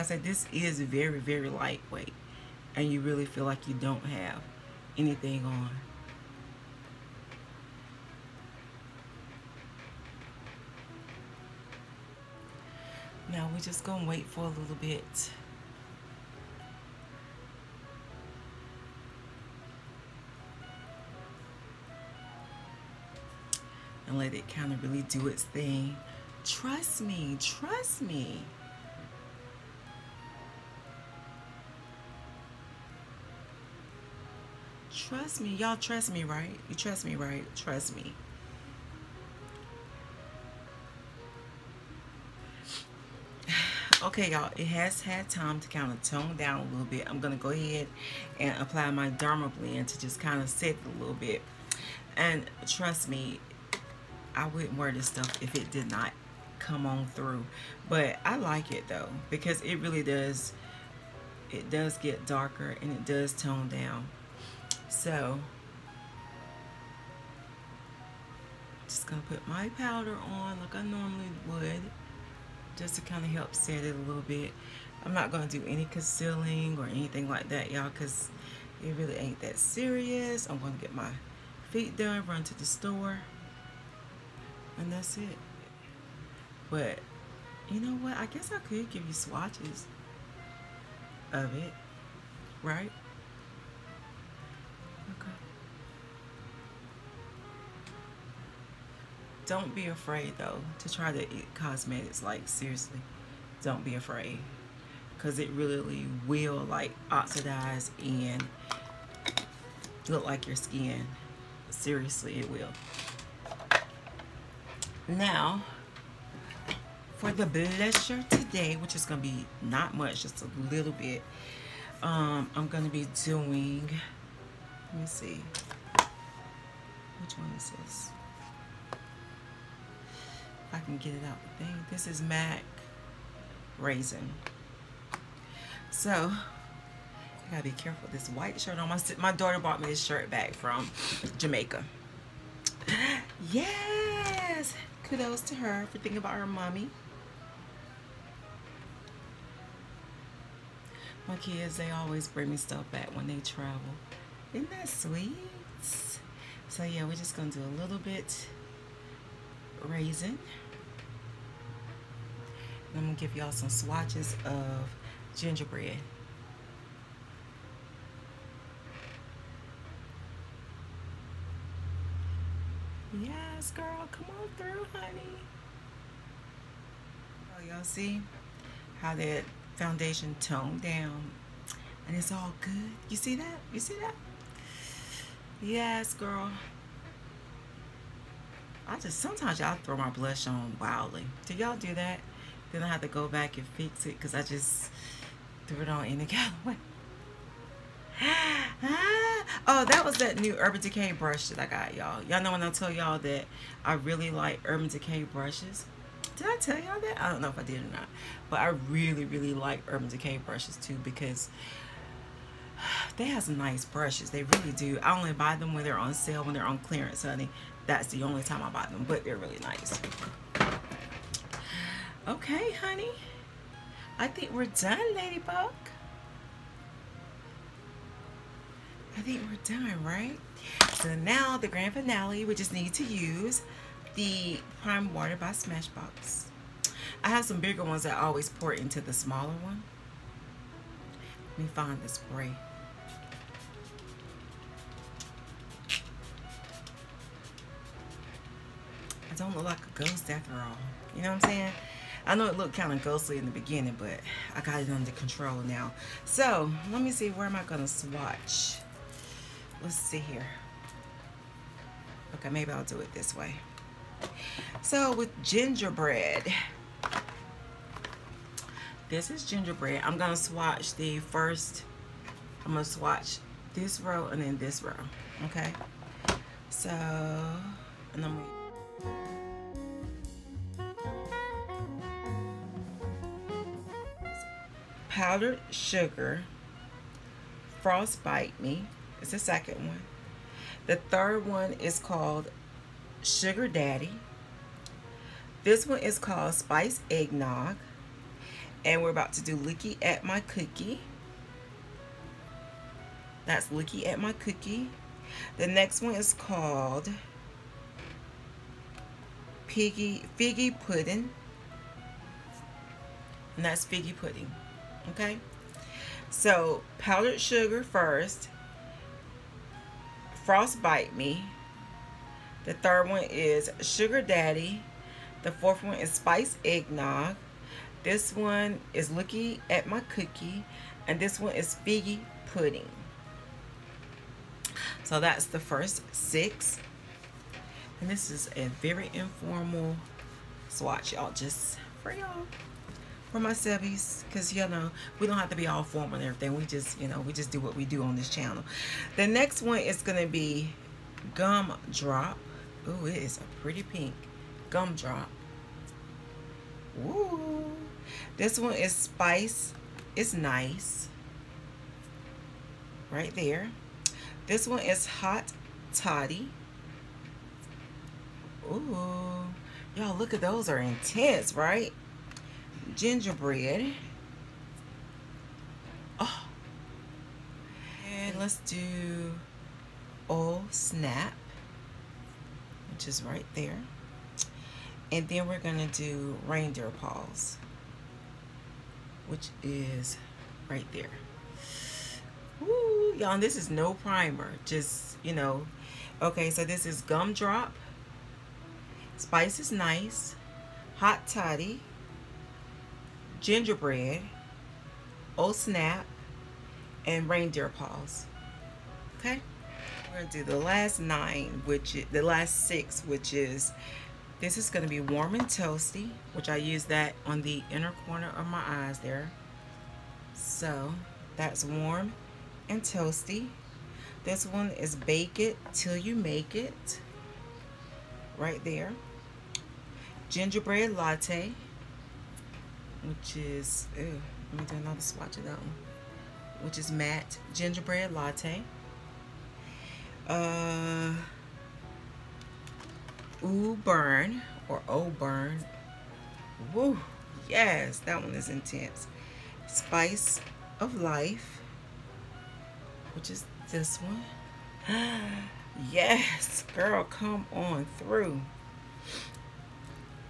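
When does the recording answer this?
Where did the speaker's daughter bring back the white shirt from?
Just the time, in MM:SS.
02:21.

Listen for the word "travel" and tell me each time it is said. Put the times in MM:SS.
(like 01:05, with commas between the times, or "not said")
02:33.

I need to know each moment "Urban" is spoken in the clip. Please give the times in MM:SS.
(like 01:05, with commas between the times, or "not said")
03:20, 03:24, 03:29.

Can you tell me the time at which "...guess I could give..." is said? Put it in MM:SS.
01:28.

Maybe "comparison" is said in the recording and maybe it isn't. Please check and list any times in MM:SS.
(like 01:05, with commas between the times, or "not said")
not said.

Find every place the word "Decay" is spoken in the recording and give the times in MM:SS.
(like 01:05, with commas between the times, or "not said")
03:20, 03:24, 03:30.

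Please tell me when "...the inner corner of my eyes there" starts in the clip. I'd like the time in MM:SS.
06:57.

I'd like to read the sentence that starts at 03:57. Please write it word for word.
I have some bigger ones that I always pour into the smaller one.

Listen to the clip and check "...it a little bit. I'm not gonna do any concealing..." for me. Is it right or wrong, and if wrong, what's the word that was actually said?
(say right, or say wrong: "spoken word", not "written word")
right.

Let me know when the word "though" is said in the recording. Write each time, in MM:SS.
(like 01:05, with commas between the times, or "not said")
00:58, 01:40.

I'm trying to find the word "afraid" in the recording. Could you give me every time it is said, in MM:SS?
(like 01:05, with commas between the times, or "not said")
01:39, 01:43.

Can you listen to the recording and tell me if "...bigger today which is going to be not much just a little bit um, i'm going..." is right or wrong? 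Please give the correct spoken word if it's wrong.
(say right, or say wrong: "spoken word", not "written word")
wrong: "blusher", not "bigger".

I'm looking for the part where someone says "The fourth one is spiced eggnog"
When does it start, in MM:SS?
05:25.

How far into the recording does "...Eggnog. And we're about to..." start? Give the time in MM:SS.
04:57.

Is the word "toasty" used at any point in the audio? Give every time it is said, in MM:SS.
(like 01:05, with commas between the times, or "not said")
06:55, 07:02.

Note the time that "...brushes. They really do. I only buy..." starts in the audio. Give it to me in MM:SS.
03:33.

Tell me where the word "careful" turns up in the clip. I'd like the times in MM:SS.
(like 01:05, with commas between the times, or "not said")
02:17.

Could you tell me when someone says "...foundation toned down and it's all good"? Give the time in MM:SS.
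02:59.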